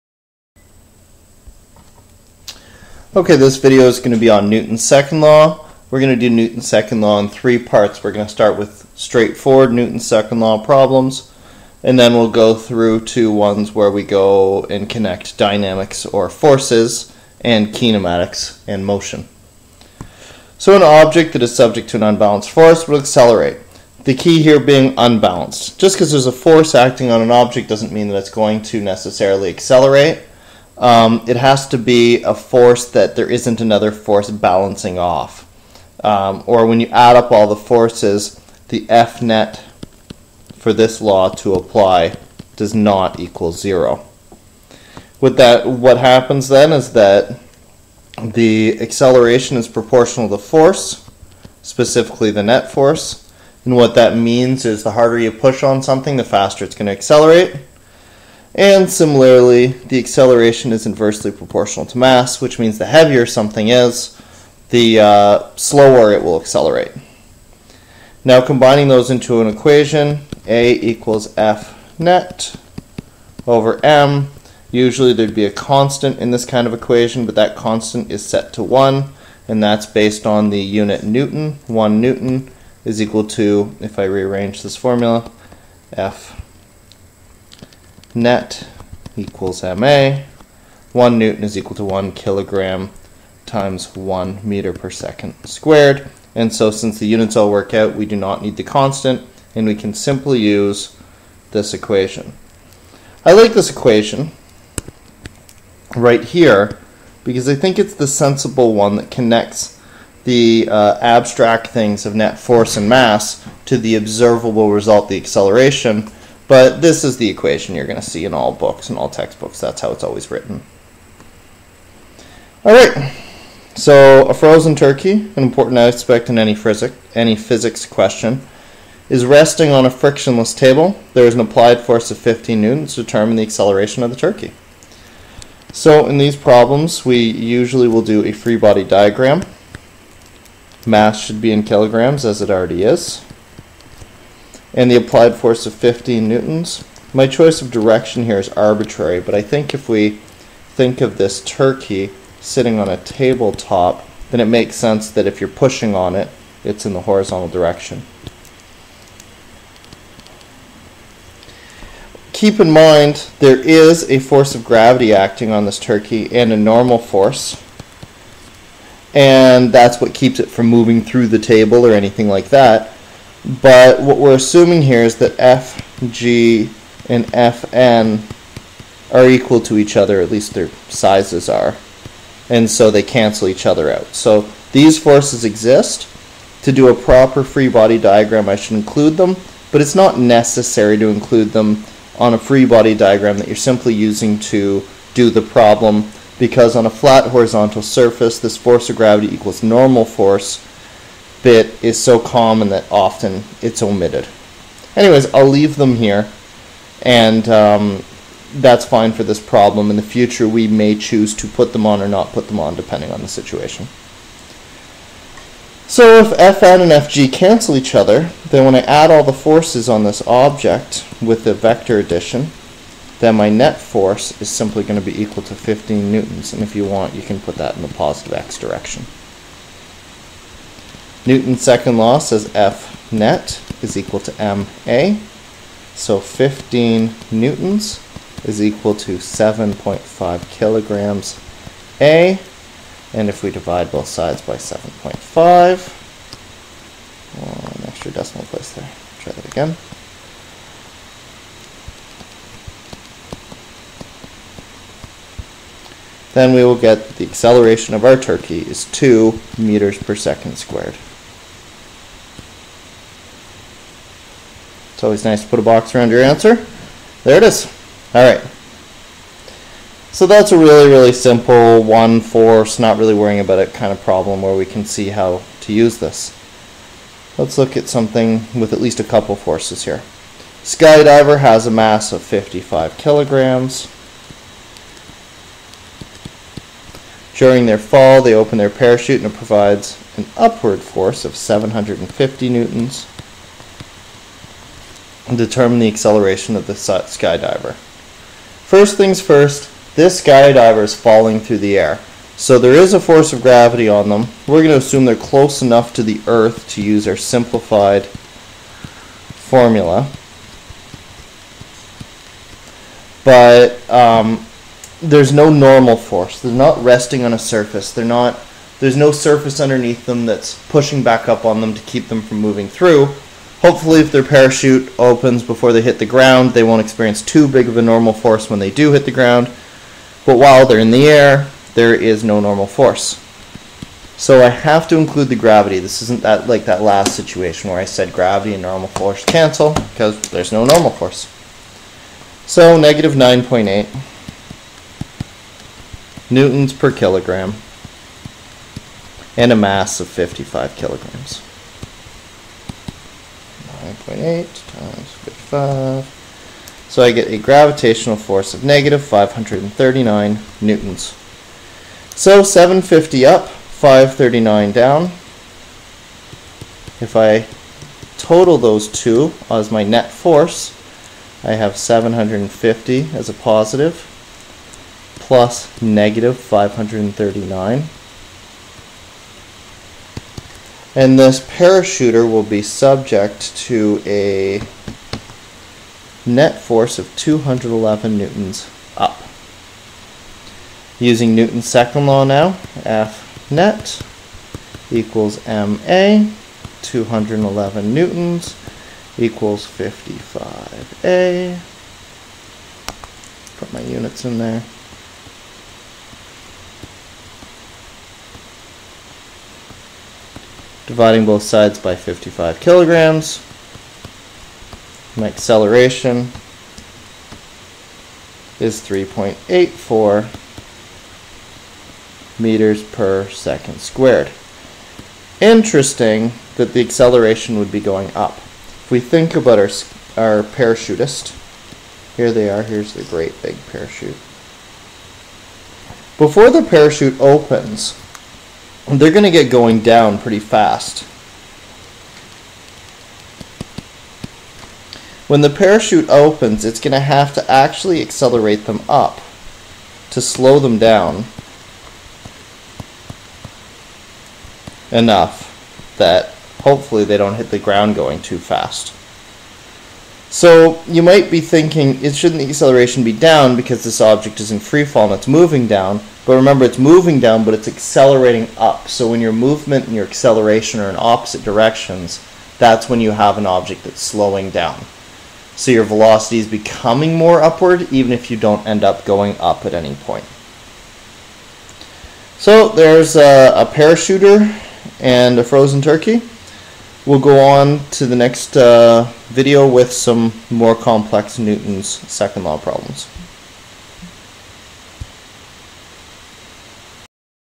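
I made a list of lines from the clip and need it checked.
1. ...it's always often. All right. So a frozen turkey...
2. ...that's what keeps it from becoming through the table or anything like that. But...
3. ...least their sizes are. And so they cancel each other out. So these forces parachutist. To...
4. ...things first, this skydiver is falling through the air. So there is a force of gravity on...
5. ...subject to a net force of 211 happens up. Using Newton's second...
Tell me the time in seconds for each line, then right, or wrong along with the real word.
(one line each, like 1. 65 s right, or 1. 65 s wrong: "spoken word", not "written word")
1. 119 s wrong: "written", not "often"
2. 169 s wrong: "moving", not "becoming"
3. 180 s wrong: "exist", not "parachutist"
4. 298 s right
5. 382 s wrong: "newtons", not "happens".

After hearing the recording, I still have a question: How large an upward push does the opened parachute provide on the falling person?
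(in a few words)
750 newtons.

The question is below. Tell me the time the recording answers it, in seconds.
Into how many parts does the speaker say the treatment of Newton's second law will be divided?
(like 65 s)
7 s.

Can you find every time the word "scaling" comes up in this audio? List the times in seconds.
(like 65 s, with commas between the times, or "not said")
not said.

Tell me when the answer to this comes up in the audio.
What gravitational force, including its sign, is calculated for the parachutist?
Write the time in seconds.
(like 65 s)
358 s.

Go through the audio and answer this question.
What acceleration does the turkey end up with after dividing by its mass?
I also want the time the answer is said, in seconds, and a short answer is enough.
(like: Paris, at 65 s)
2 meters per second squared, at 258 s.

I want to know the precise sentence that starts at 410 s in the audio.
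dividing both sides by 55 kilograms.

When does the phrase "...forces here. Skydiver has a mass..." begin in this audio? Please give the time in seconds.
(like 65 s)
279 s.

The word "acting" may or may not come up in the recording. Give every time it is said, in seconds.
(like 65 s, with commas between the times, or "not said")
26 s, 165 s.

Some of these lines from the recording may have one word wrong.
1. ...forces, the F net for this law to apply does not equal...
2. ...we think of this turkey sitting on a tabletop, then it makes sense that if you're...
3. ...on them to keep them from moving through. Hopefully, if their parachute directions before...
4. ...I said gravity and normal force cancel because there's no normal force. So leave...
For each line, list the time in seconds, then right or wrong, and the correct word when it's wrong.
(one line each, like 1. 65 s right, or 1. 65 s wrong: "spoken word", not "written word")
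1. 37 s right
2. 149 s right
3. 321 s wrong: "opens", not "directions"
4. 337 s wrong: "negative", not "leave".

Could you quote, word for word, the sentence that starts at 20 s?
So an object that is subject to an unbalanced force will accelerate.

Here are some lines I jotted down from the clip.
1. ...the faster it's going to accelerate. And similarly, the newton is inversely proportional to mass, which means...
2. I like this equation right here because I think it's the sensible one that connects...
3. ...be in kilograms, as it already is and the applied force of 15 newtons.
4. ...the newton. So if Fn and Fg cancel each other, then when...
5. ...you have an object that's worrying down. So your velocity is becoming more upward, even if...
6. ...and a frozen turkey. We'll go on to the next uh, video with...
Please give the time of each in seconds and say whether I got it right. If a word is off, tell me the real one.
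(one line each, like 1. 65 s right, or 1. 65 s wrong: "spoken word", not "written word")
1. 56 s wrong: "acceleration", not "newton"
2. 103 s right
3. 141 s right
4. 213 s wrong: "situation", not "newton"
5. 473 s wrong: "slowing", not "worrying"
6. 484 s right.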